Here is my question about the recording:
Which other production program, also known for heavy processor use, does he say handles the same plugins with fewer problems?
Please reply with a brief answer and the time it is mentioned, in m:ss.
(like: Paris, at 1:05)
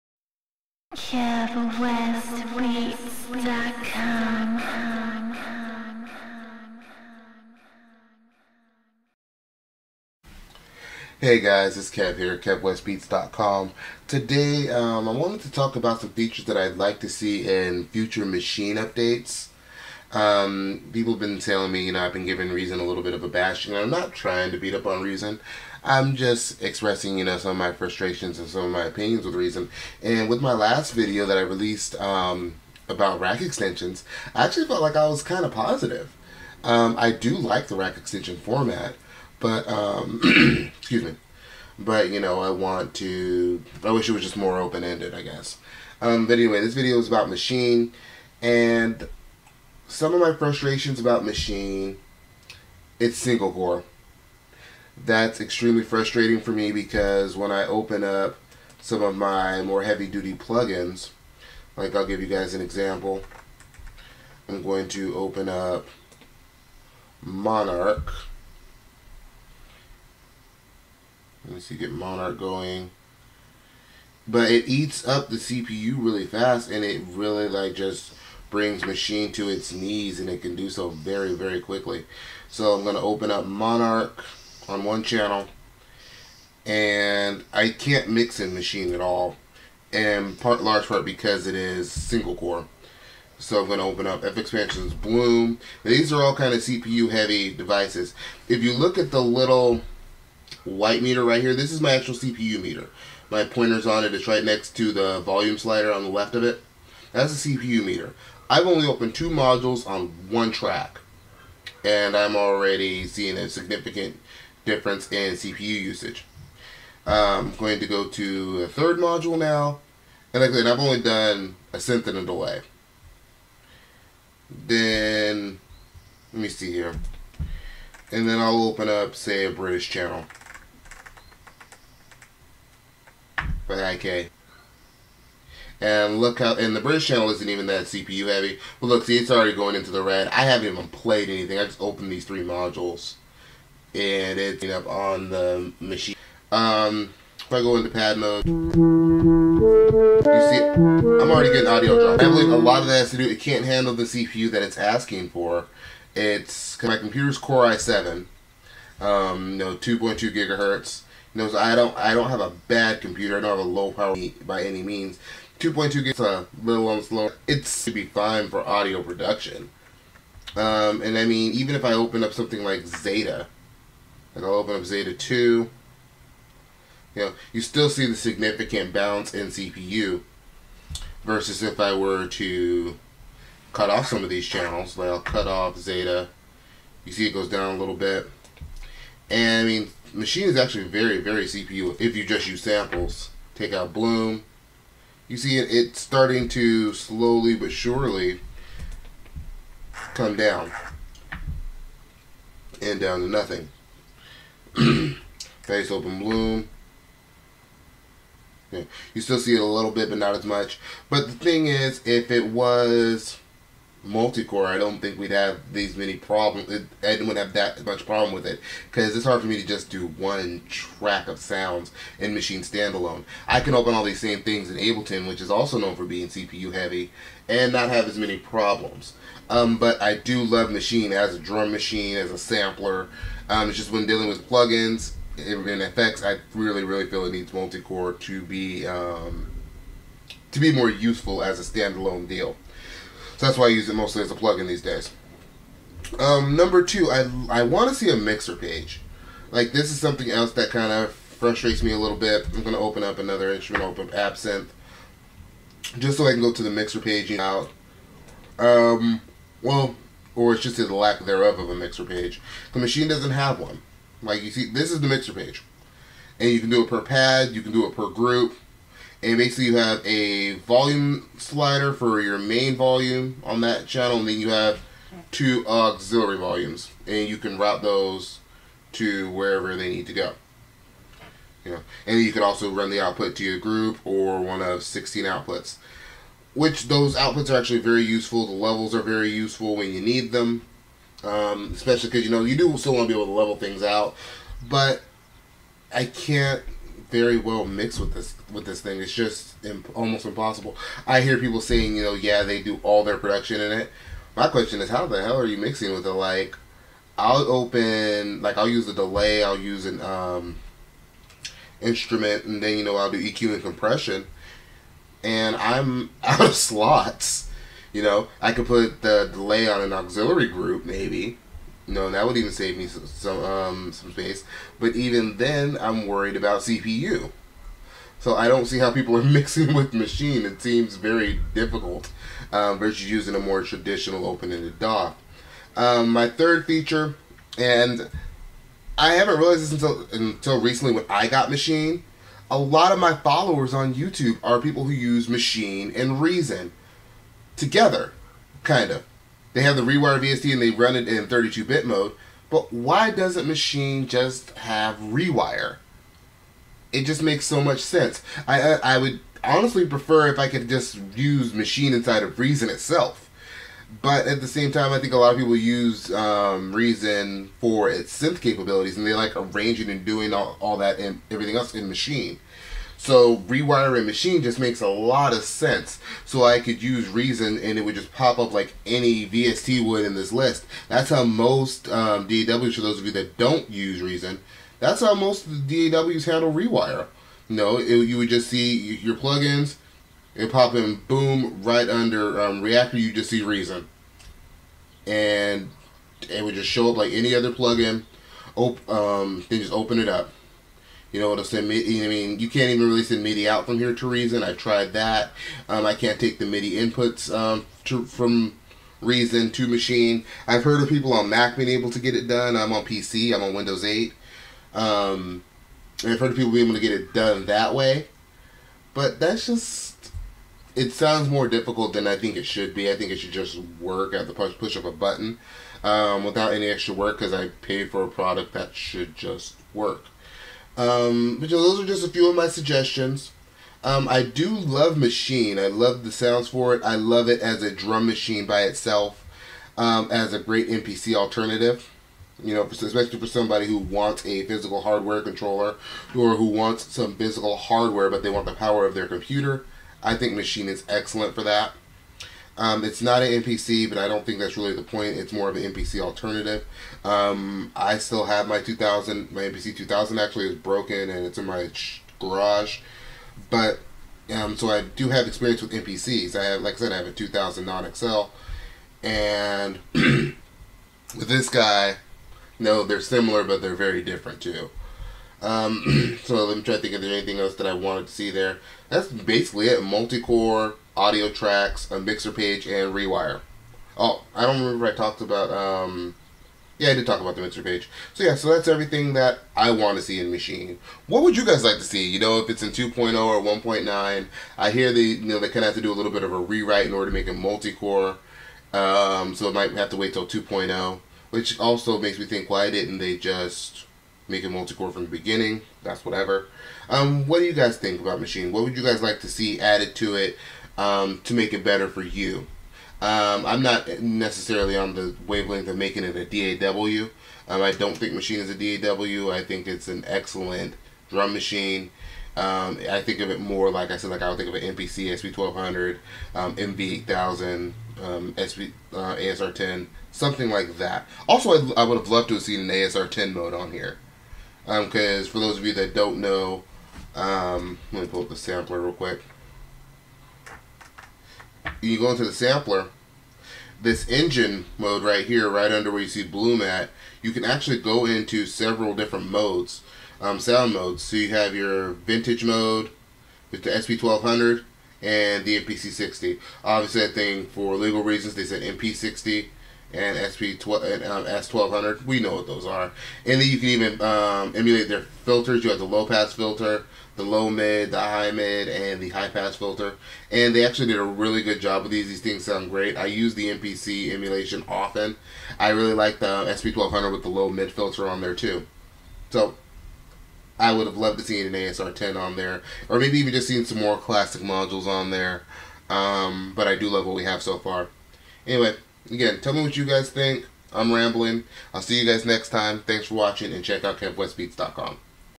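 Ableton, at 3:44.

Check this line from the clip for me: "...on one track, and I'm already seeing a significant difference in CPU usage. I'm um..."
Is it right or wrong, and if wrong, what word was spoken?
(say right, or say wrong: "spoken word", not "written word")
right.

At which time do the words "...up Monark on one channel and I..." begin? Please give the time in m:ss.
1:23.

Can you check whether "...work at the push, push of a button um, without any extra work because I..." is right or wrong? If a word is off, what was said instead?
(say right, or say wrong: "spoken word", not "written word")
right.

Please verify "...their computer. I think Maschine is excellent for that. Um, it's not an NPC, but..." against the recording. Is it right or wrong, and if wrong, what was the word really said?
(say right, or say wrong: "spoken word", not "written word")
right.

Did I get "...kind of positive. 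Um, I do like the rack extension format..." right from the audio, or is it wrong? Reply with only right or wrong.
right.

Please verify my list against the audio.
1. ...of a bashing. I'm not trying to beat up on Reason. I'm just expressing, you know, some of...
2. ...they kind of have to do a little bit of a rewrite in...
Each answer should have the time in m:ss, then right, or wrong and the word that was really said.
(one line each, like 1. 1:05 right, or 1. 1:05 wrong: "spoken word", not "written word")
1. 0:23 right
2. 8:15 right.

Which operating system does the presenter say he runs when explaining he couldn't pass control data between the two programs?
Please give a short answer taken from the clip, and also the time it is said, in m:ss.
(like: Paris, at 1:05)
Windows 8, at 6:53.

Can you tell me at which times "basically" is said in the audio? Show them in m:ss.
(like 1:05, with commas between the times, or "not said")
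4:29, 7:59.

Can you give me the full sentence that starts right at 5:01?
I hear people saying, you know, yeah, they do all their production in it.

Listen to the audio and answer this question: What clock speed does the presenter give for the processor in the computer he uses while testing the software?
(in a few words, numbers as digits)
2.2 GHz.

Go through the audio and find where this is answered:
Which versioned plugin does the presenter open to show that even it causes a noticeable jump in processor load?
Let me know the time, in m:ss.
2:54.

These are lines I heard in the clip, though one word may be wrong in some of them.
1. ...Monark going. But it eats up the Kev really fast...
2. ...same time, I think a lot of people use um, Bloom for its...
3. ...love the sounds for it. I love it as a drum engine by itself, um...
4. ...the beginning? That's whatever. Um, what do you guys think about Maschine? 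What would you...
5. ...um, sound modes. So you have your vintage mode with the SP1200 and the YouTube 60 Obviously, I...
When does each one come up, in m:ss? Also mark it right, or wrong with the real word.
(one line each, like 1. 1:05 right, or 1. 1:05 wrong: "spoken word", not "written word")
1. 1:11 wrong: "CPU", not "Kev"
2. 6:04 wrong: "Reason", not "Bloom"
3. 7:15 wrong: "machine", not "engine"
4. 8:25 right
5. 9:10 wrong: "MPC", not "YouTube".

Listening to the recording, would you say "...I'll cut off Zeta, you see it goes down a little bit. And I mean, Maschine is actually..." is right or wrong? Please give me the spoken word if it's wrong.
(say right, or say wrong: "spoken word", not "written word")
right.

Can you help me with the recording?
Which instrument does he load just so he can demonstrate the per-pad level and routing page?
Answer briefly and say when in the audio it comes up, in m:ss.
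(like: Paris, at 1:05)
Absynth, at 4:14.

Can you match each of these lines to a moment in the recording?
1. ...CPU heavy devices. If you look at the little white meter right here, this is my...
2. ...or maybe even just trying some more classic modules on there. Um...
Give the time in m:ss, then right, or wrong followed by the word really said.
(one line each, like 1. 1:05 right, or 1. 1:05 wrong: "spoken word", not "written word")
1. 1:36 right
2. 9:42 wrong: "seeing", not "trying".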